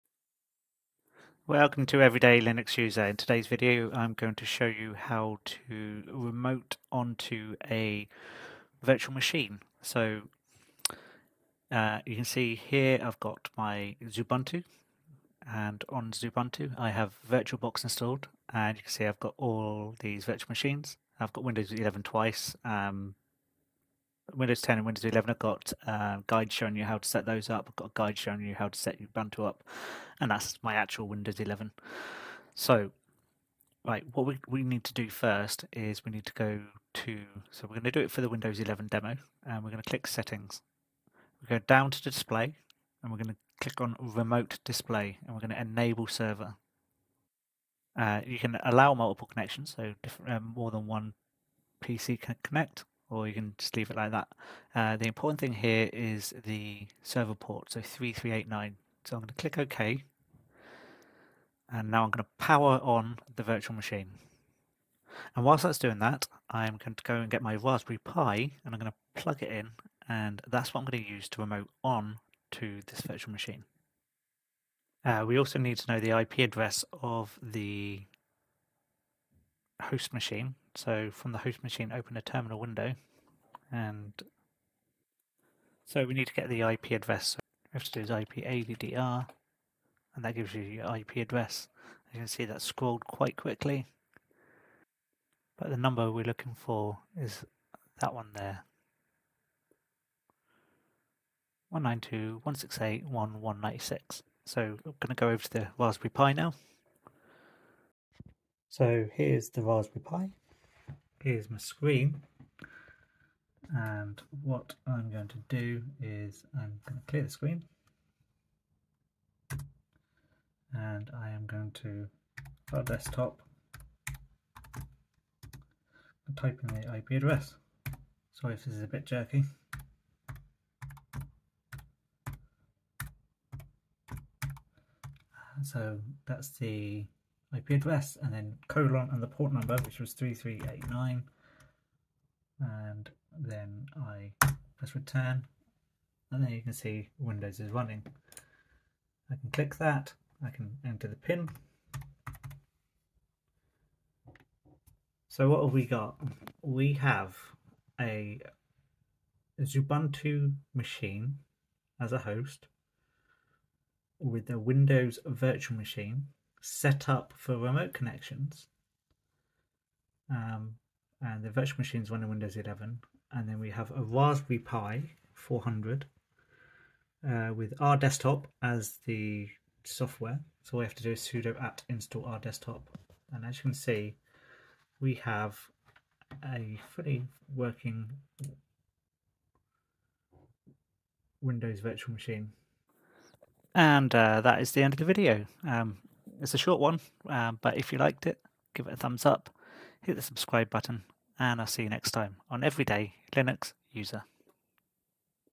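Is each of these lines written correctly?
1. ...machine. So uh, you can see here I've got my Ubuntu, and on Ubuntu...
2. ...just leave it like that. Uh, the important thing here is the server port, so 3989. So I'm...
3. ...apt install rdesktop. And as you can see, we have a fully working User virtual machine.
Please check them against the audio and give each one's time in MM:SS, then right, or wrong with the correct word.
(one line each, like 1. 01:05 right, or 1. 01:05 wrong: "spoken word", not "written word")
1. 00:09 right
2. 00:53 wrong: "3389", not "3989"
3. 03:01 wrong: "Windows", not "User".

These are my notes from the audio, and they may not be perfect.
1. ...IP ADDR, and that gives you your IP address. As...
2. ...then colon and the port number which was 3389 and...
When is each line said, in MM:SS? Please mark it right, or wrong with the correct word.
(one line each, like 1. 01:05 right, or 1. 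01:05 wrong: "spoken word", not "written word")
1. 01:28 right
2. 02:18 right.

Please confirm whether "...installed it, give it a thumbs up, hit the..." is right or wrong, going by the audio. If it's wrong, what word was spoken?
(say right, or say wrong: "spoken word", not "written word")
wrong: "liked", not "installed".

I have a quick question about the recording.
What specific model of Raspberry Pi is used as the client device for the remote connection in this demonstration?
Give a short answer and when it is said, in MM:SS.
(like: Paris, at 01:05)
Raspberry Pi 400, at 02:54.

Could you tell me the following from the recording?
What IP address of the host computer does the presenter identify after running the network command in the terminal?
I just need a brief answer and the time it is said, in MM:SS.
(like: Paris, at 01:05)
192.168.1.196, at 01:41.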